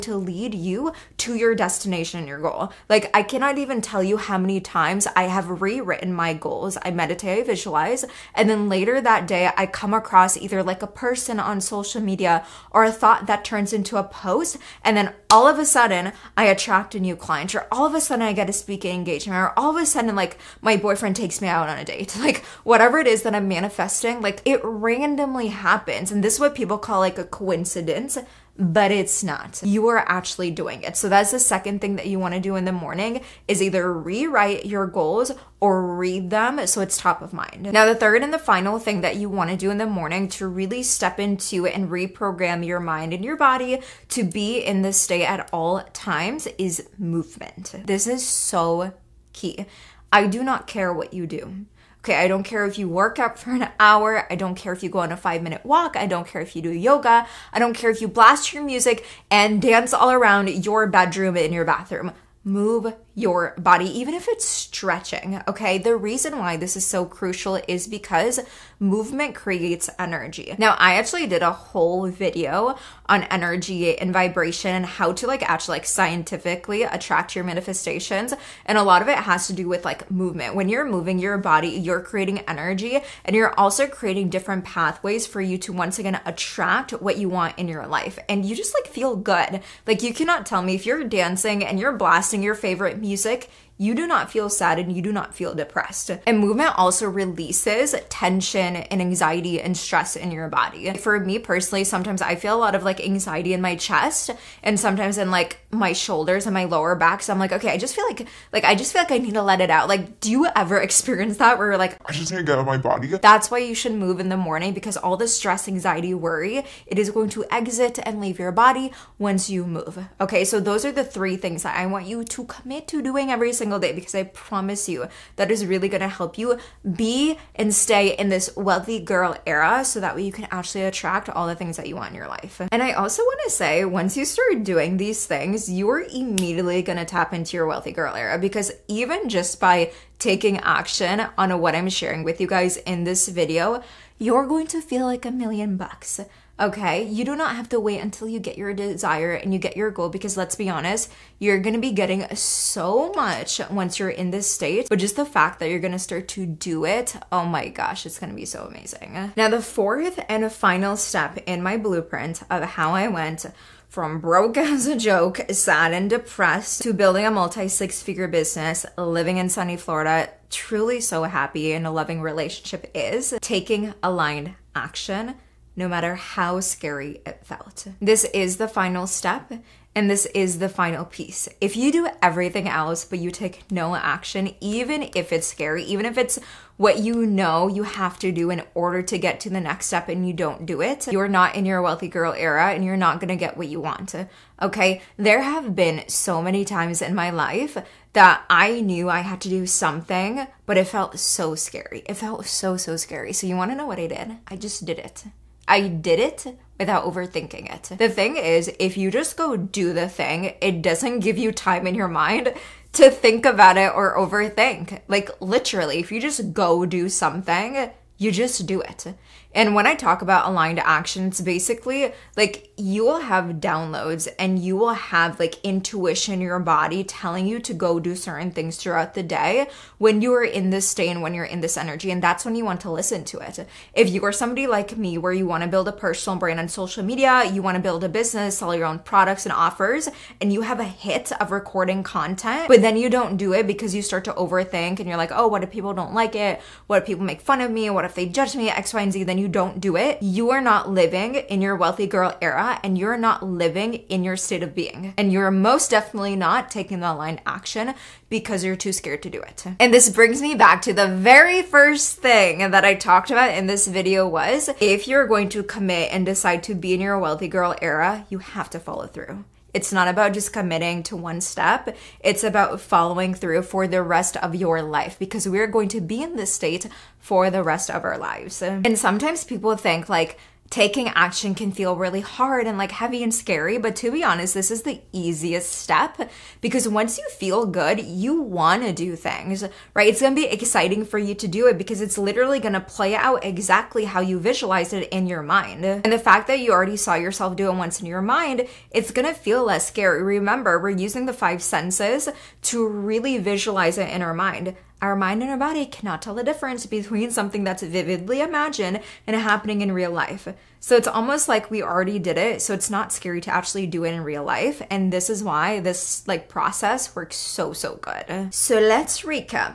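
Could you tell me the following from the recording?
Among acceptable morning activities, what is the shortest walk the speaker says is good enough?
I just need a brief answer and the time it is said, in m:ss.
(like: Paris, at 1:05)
5 minute walk, at 0:55.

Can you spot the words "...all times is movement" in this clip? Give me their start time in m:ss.
0:45.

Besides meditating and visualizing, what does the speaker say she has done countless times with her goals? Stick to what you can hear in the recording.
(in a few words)
rewritten.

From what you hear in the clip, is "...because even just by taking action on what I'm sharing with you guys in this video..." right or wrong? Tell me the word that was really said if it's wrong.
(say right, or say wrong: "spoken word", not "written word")
right.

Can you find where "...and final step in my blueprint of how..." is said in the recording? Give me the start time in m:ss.
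2:40.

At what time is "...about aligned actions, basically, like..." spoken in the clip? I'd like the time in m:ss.
3:40.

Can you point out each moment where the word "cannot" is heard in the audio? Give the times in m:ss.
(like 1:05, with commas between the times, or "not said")
0:03, 1:30, 5:05.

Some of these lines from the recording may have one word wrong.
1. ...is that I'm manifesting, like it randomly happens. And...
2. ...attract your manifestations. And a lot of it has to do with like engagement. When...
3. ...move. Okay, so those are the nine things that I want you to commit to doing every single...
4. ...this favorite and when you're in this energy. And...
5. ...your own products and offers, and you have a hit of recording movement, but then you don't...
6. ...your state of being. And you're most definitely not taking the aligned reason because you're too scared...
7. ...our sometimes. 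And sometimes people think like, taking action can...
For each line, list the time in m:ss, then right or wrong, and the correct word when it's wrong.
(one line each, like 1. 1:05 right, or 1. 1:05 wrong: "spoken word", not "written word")
1. 0:23 right
2. 1:16 wrong: "movement", not "engagement"
3. 1:59 wrong: "three", not "nine"
4. 3:50 wrong: "state", not "favorite"
5. 3:58 wrong: "content", not "movement"
6. 4:14 wrong: "action", not "reason"
7. 4:38 wrong: "lives", not "sometimes".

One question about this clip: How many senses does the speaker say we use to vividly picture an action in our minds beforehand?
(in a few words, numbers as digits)
5.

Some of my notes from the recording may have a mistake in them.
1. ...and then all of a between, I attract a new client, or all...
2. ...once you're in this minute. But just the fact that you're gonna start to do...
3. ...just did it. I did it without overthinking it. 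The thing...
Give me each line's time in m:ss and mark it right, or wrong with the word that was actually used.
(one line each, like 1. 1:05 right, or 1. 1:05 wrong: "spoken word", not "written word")
1. 0:14 wrong: "sudden", not "between"
2. 2:33 wrong: "state", not "minute"
3. 3:24 right.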